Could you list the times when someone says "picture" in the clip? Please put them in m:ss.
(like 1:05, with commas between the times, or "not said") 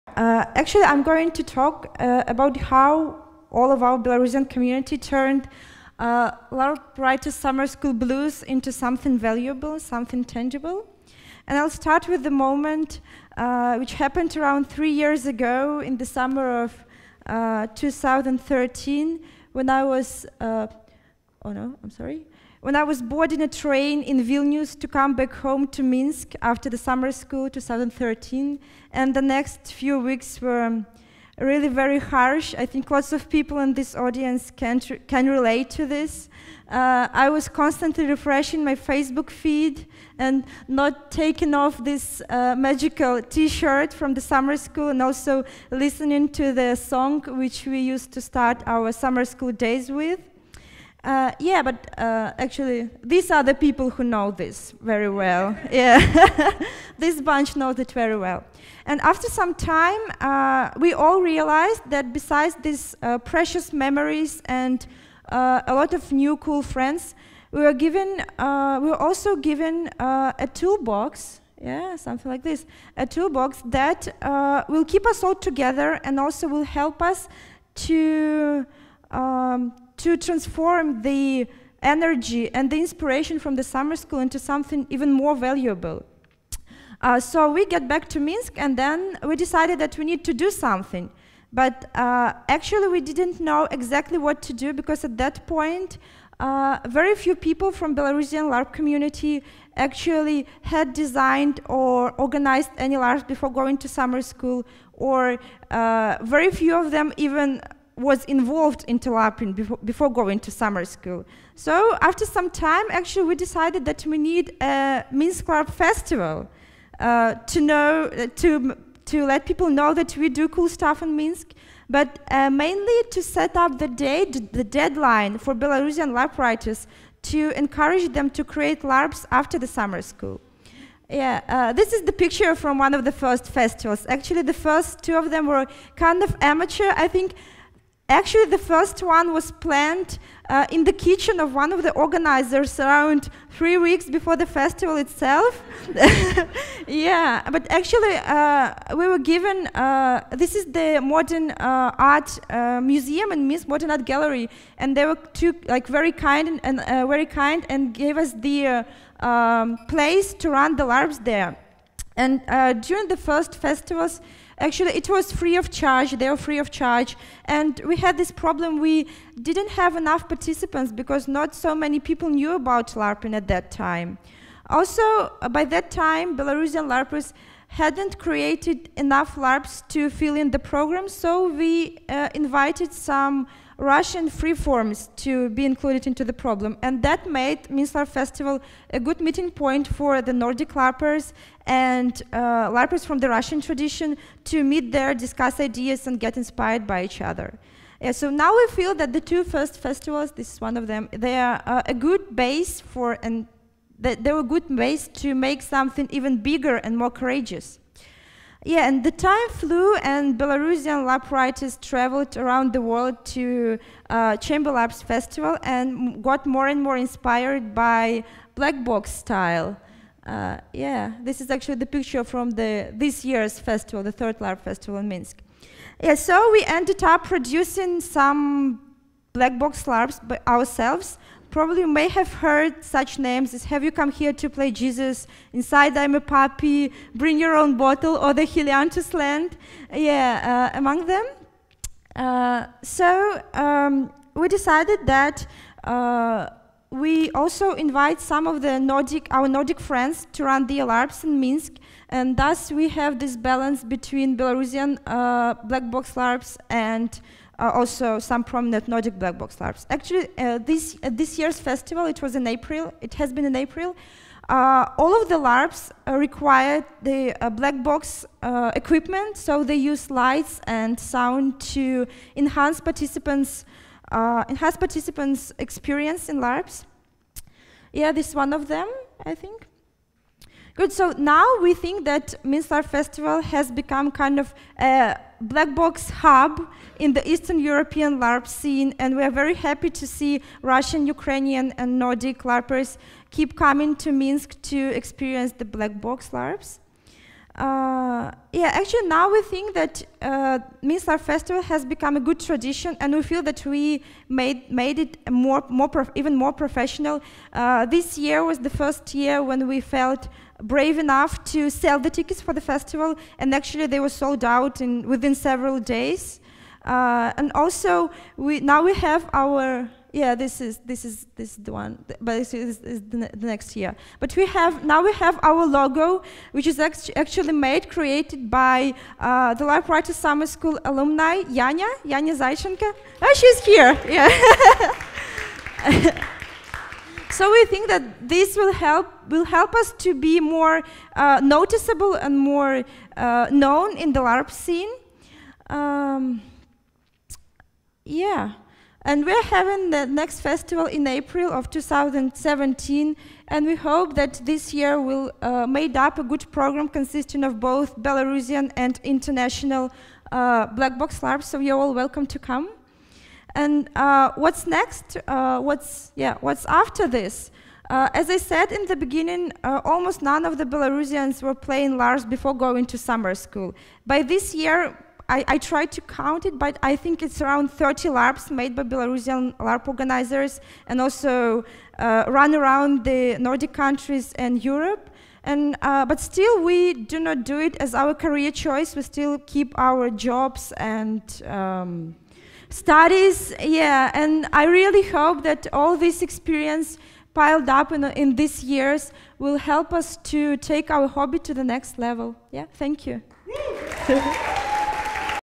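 2:12, 3:41.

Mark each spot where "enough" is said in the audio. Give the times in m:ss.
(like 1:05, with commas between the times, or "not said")
2:49, 2:58, 5:10.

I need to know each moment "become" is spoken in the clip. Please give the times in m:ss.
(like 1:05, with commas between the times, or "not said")
4:43, 5:01.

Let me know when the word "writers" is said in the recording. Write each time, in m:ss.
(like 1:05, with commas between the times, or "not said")
2:06, 3:31, 5:29.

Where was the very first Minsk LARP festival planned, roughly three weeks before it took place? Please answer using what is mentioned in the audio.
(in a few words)
In the kitchen.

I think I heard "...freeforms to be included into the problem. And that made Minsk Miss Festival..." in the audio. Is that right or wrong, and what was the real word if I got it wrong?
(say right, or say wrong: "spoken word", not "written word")
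wrong: "LARP", not "Miss".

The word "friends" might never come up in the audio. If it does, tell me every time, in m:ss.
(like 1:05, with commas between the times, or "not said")
1:06, 4:09.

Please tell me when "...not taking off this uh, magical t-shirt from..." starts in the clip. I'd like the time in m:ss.
0:40.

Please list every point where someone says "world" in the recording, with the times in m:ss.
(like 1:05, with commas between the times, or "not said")
3:32.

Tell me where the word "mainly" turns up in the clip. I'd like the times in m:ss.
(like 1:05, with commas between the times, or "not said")
2:02.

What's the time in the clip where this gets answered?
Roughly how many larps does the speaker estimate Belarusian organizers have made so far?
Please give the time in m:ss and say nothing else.
6:17.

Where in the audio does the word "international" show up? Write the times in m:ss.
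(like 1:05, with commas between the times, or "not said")
5:59.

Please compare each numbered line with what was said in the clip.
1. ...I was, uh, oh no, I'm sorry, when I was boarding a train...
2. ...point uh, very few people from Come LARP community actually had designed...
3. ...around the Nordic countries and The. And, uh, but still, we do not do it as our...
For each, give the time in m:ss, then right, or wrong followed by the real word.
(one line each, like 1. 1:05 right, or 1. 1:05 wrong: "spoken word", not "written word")
1. 0:19 right
2. 1:35 wrong: "Belarusian", not "Come"
3. 6:22 wrong: "Europe", not "The".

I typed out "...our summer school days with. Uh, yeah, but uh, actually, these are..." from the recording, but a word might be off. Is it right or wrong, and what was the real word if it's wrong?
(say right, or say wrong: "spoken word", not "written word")
right.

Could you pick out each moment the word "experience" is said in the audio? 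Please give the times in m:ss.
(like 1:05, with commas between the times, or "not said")
4:35, 4:54, 6:36.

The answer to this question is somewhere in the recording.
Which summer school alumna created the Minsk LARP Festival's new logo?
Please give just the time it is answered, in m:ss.
5:32.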